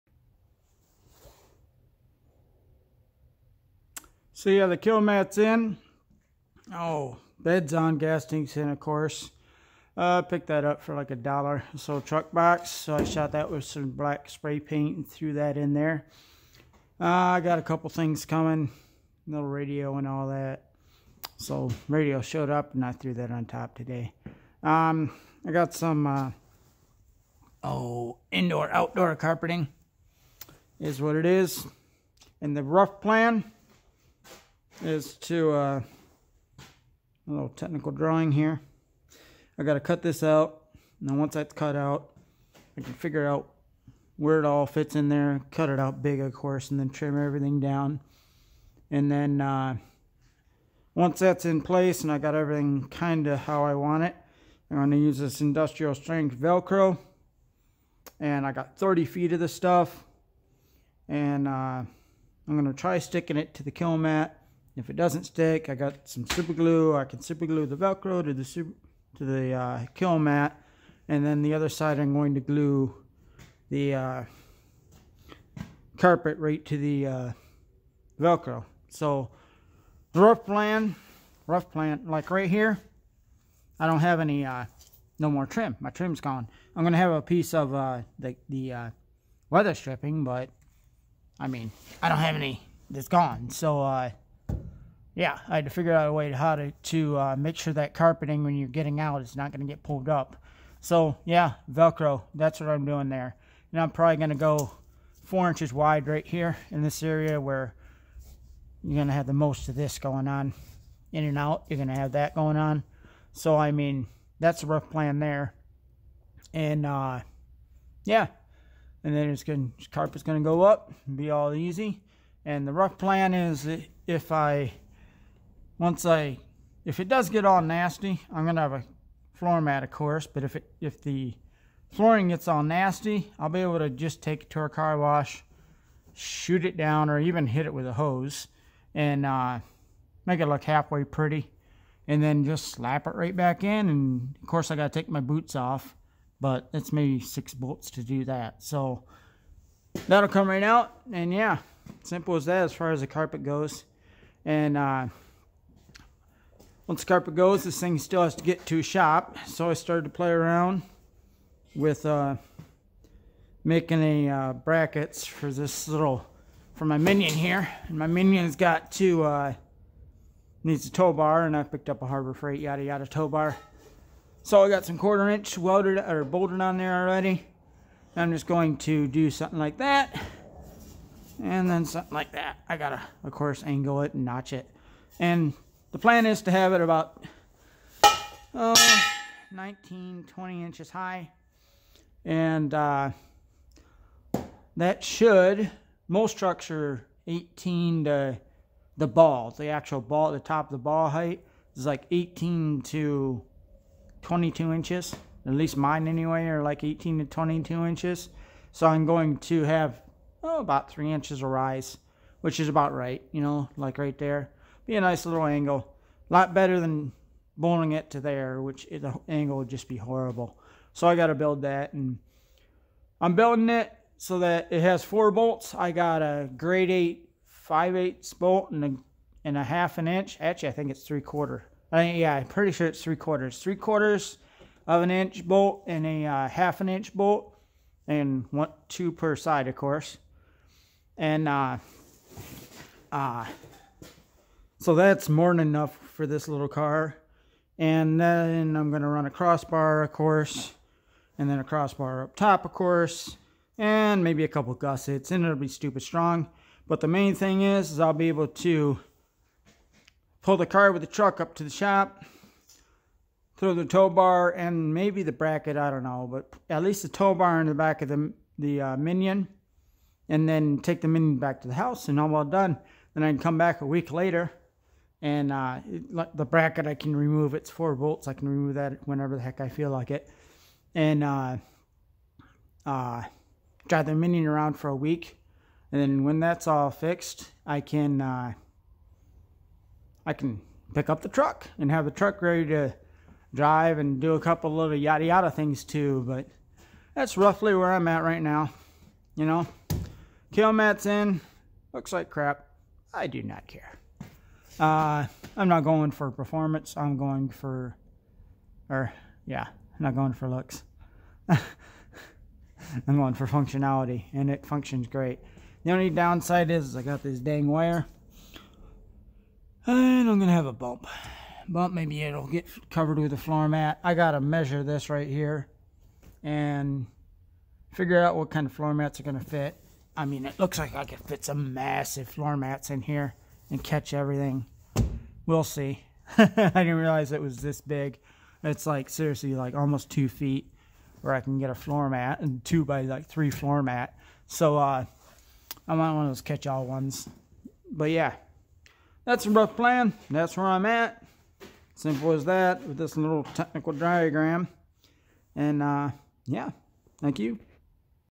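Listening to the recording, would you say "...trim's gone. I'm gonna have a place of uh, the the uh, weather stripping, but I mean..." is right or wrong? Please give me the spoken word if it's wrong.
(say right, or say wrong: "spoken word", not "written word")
wrong: "piece", not "place".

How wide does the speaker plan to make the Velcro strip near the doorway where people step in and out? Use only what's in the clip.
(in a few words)
4 inches.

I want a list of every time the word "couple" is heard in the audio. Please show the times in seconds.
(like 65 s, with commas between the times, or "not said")
17 s, 254 s, 294 s.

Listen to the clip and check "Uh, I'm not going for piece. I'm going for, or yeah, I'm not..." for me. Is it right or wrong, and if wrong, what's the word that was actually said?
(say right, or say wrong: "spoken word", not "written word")
wrong: "performance", not "piece".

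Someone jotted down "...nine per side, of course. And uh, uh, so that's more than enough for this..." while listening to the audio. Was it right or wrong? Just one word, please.
wrong.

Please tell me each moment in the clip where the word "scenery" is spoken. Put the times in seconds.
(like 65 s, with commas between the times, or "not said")
not said.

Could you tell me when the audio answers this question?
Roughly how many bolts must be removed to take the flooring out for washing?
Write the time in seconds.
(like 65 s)
147 s.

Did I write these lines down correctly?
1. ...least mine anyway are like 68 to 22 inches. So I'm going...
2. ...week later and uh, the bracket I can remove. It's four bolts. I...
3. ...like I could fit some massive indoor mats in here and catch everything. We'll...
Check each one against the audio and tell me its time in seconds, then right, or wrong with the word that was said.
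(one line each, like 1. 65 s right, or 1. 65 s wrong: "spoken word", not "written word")
1. 205 s wrong: "18", not "68"
2. 273 s right
3. 330 s wrong: "floor", not "indoor".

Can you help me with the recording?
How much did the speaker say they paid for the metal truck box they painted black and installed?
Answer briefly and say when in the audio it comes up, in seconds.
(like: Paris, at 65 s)
$1, at 10 s.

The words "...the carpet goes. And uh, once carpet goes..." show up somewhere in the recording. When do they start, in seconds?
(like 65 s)
153 s.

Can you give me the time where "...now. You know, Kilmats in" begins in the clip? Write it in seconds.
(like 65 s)
298 s.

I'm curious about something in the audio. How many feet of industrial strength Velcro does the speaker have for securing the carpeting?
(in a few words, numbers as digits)
30 feet.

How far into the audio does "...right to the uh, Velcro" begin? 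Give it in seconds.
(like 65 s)
76 s.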